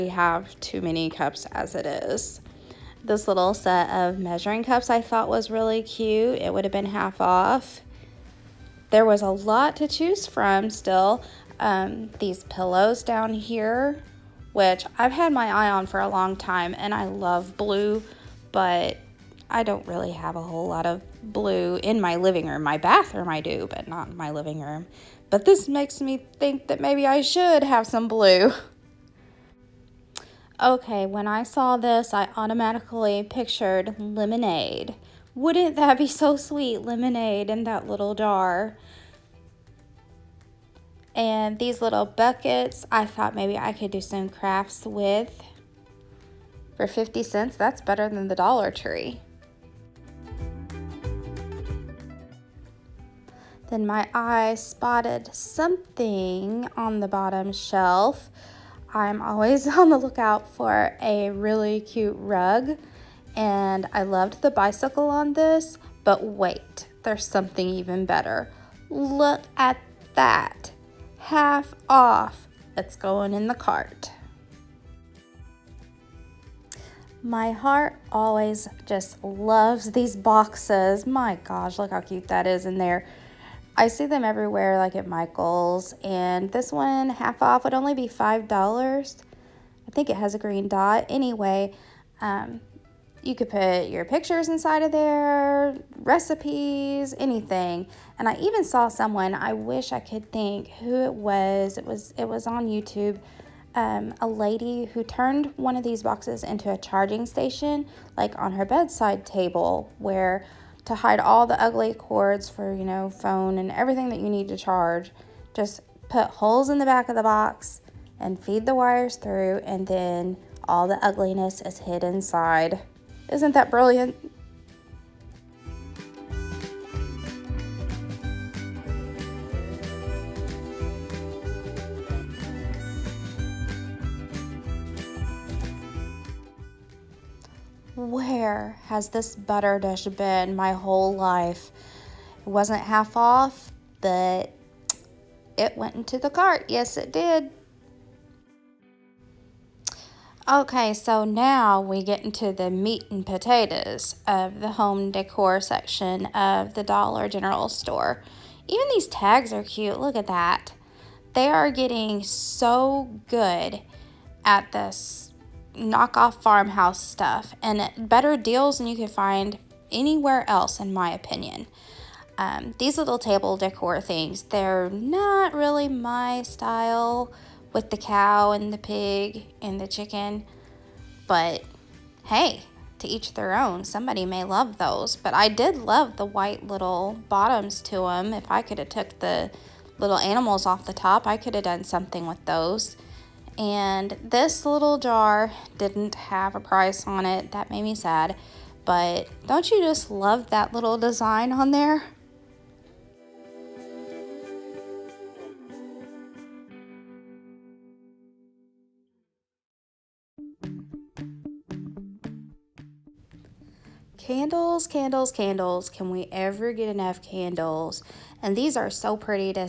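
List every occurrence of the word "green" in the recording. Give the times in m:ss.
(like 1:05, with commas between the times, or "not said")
1:30.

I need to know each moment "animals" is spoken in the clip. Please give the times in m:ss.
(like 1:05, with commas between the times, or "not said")
3:10.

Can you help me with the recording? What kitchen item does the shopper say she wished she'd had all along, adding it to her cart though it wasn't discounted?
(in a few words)
butter dish.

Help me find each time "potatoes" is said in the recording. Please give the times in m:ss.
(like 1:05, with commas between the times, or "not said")
2:33.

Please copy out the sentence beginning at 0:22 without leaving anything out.
My bathroom I do, but not in my living room.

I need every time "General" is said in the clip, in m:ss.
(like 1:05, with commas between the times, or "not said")
2:37.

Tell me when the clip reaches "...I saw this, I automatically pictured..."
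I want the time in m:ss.
0:31.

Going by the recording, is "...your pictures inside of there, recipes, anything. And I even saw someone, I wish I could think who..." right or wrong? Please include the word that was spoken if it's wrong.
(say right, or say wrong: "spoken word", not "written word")
right.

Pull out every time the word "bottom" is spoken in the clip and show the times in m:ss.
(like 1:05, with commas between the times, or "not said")
0:57, 3:07.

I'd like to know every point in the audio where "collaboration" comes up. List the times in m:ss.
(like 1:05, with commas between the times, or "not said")
not said.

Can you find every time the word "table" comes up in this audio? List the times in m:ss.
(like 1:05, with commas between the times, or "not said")
1:49, 2:53.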